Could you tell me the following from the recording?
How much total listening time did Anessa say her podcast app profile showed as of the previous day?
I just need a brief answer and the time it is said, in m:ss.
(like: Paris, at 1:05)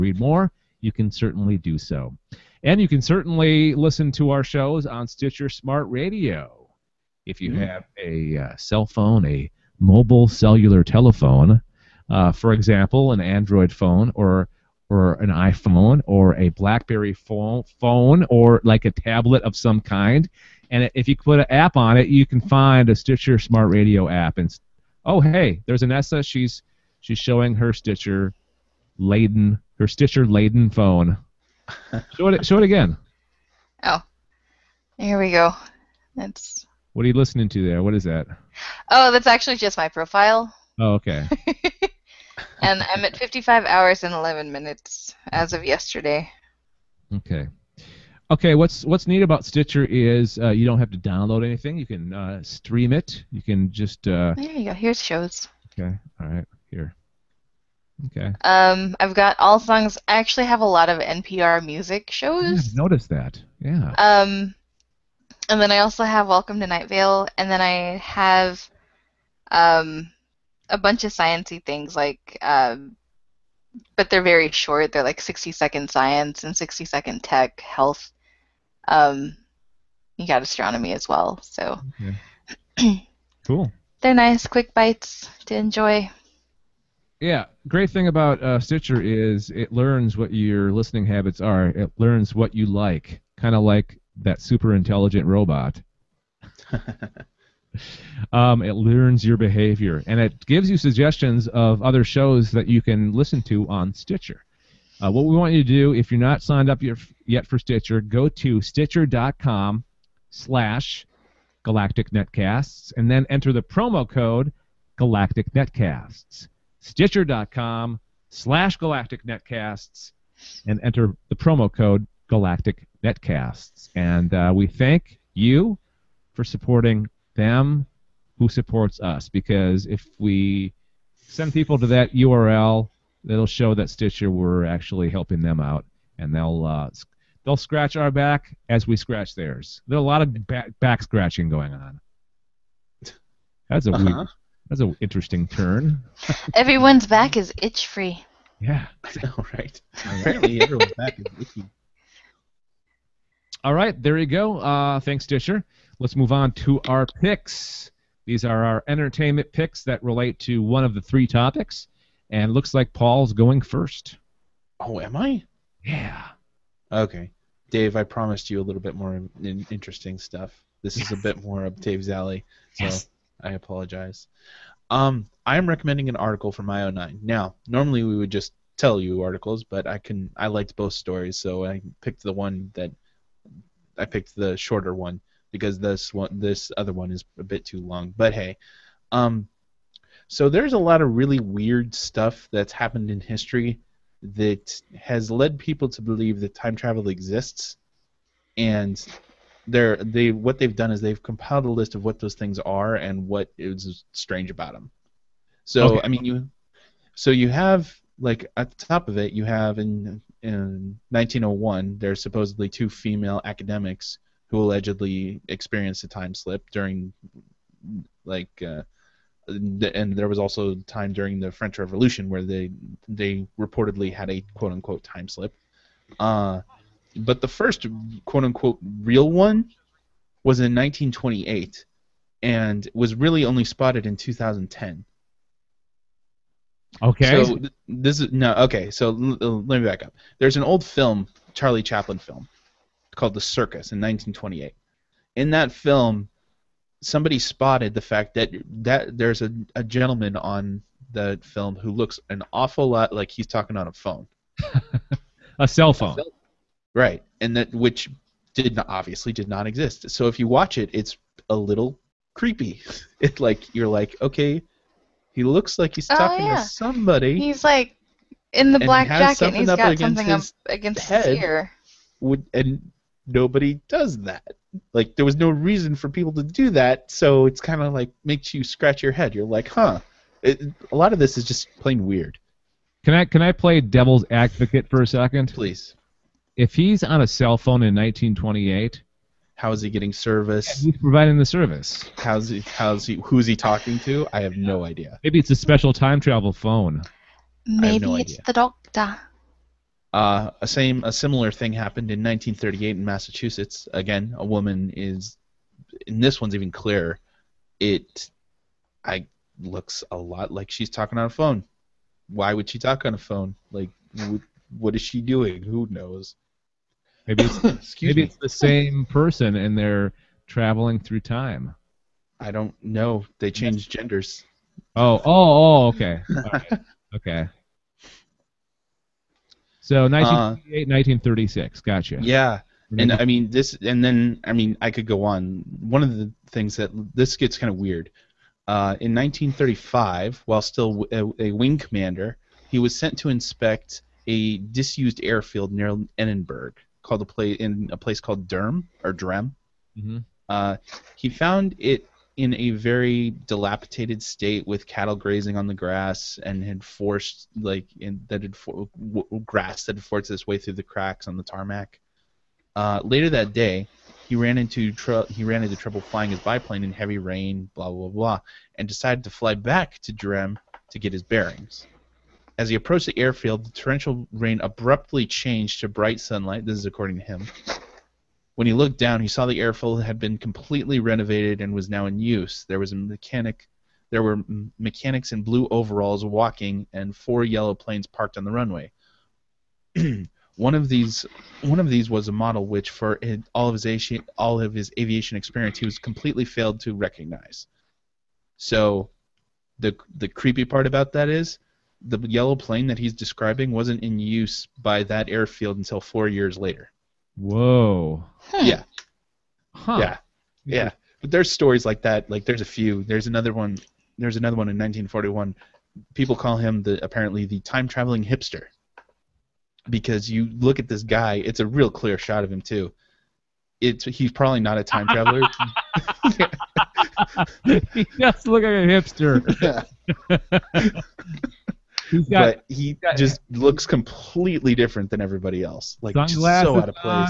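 55 hours and 11 minutes, at 0:43.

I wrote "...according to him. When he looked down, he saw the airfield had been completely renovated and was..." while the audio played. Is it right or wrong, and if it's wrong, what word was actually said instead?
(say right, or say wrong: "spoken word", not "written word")
right.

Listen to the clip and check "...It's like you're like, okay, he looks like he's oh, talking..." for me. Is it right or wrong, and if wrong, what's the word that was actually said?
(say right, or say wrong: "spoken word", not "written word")
right.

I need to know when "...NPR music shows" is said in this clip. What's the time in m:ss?
1:01.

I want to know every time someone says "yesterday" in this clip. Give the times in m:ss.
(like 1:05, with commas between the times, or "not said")
0:45.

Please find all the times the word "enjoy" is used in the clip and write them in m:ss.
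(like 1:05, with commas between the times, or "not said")
1:25.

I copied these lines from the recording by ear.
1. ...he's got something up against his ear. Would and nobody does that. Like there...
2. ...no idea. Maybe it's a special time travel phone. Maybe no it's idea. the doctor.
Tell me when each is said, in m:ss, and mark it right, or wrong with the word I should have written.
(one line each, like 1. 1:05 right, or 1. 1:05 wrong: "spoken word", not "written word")
1. 4:29 right
2. 4:54 right.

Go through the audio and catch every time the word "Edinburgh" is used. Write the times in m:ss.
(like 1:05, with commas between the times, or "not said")
5:46.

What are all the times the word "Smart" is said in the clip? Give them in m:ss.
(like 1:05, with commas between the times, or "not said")
0:05, 0:23.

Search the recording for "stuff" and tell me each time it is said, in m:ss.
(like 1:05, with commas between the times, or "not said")
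2:50, 3:11.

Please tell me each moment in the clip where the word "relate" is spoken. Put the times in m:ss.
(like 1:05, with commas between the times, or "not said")
2:40.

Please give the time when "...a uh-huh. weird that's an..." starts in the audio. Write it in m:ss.
2:23.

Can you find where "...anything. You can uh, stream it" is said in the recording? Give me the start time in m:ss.
0:51.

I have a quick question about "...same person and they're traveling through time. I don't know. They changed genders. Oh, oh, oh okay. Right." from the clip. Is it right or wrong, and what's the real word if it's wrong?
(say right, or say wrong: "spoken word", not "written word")
right.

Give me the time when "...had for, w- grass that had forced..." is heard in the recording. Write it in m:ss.
5:58.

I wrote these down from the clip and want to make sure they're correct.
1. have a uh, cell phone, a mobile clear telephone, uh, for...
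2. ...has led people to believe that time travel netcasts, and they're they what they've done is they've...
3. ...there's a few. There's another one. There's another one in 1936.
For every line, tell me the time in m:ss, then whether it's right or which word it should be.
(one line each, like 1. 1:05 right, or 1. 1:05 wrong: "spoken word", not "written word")
1. 0:07 wrong: "cellular", not "clear"
2. 3:14 wrong: "exists", not "netcasts"
3. 6:52 wrong: "1941", not "1936".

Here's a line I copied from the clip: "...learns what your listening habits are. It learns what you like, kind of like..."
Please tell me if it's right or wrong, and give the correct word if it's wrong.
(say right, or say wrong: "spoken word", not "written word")
right.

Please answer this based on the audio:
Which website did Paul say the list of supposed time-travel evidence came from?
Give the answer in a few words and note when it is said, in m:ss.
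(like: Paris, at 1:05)
IO9, at 2:56.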